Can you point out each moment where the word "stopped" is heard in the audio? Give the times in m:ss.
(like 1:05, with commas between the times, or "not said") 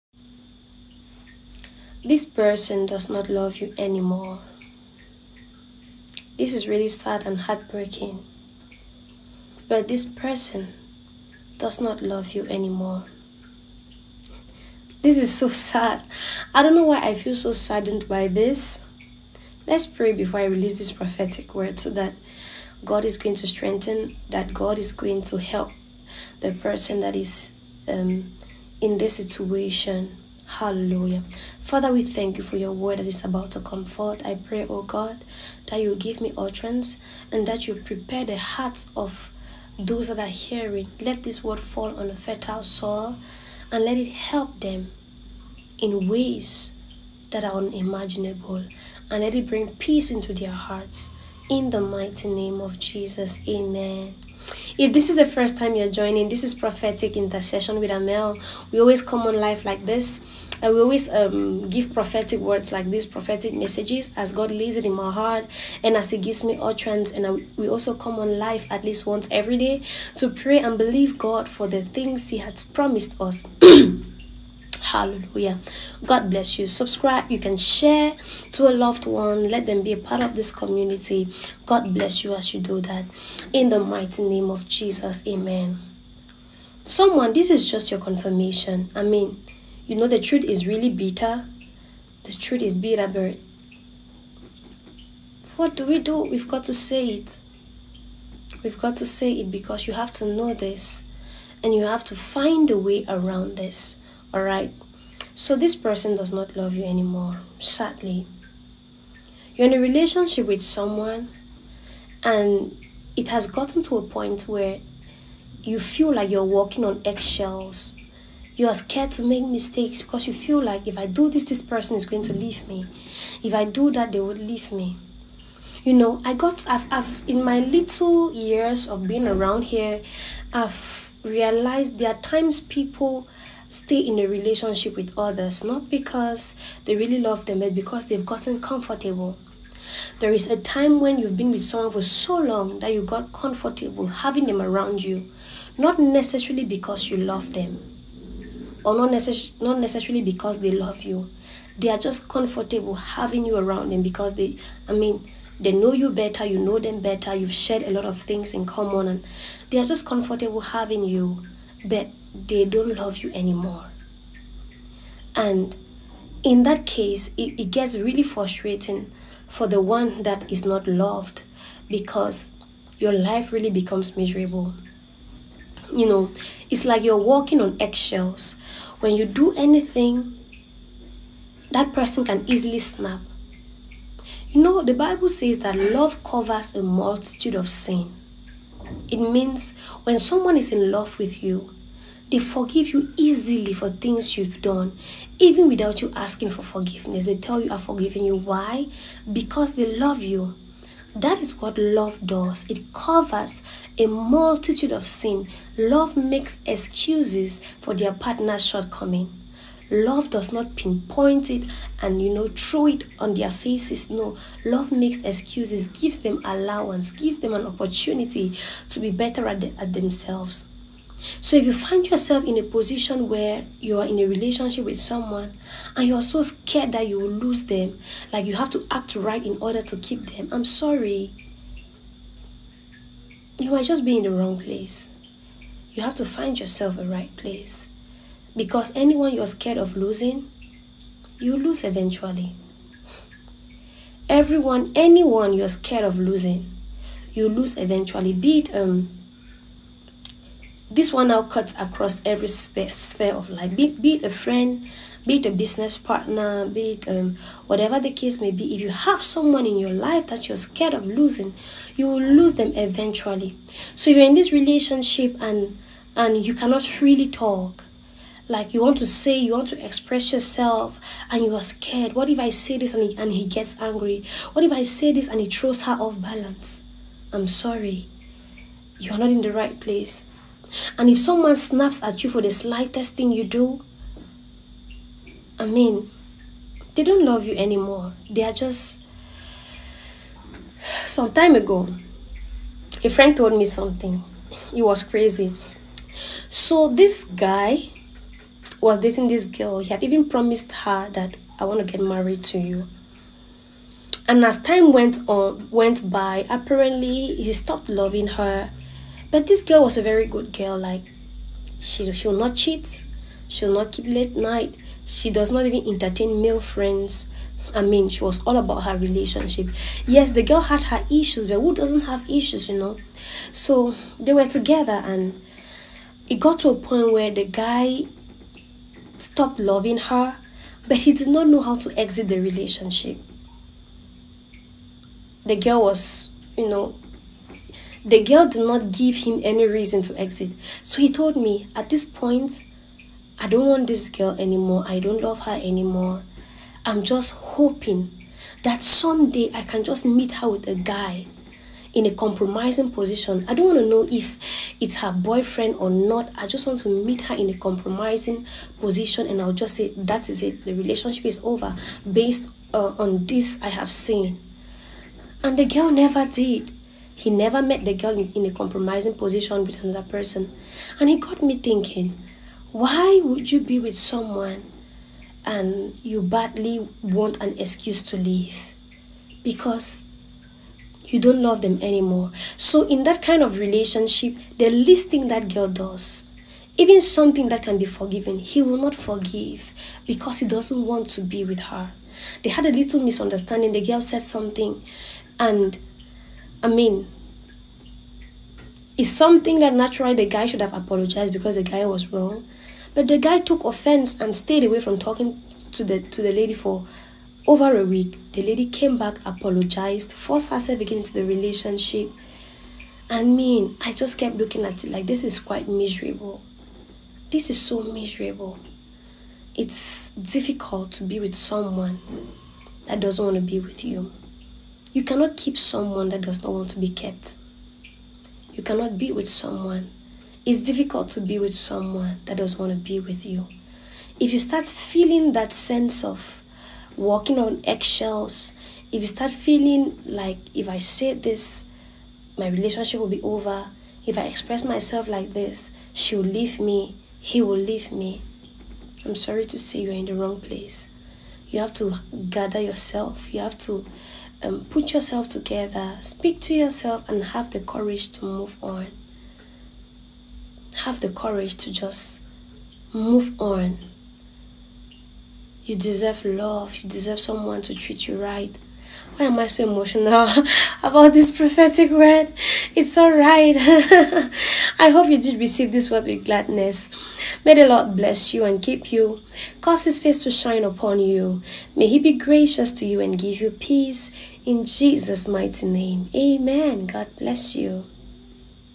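5:07, 5:29.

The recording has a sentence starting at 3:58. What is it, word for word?
Because anyone you're scared of losing, you lose eventually.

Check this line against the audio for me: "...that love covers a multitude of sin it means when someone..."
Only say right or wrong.
right.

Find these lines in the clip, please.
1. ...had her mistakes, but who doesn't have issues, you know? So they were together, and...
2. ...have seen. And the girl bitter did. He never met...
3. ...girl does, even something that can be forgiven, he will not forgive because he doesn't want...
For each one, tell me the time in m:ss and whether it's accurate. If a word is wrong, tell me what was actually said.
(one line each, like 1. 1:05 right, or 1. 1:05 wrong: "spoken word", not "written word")
1. 5:20 wrong: "issues", not "mistakes"
2. 6:03 wrong: "never", not "bitter"
3. 6:25 right.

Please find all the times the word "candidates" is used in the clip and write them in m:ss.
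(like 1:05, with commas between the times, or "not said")
not said.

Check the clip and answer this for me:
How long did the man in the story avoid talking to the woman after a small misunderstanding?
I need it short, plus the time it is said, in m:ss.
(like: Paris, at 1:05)
over a week, at 6:47.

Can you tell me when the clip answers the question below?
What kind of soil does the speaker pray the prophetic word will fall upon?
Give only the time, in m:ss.
0:42.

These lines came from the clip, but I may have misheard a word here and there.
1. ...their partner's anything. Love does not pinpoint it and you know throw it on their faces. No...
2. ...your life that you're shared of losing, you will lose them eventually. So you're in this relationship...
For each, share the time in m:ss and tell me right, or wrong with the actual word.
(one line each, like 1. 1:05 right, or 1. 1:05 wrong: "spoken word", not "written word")
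1. 3:27 wrong: "shortcoming", not "anything"
2. 4:19 wrong: "scared", not "shared".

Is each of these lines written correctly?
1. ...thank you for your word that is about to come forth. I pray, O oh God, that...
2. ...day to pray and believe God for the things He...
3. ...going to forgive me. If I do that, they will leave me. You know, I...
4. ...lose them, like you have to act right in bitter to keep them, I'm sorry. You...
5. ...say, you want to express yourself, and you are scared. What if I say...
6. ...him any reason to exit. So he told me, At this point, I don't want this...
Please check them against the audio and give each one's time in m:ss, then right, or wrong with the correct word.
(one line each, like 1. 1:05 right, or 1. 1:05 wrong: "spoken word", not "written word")
1. 0:32 right
2. 1:09 right
3. 2:02 wrong: "leave", not "forgive"
4. 3:47 wrong: "order", not "bitter"
5. 4:29 right
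6. 5:39 right.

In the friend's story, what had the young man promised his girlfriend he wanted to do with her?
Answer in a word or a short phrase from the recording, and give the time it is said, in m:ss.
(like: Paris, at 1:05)
get married, at 5:01.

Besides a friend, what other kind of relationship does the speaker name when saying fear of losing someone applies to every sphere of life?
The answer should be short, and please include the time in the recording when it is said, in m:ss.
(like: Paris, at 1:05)
business partner, at 4:15.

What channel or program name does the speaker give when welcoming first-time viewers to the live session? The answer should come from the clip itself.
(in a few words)
Prophetic Intercession with Armelle.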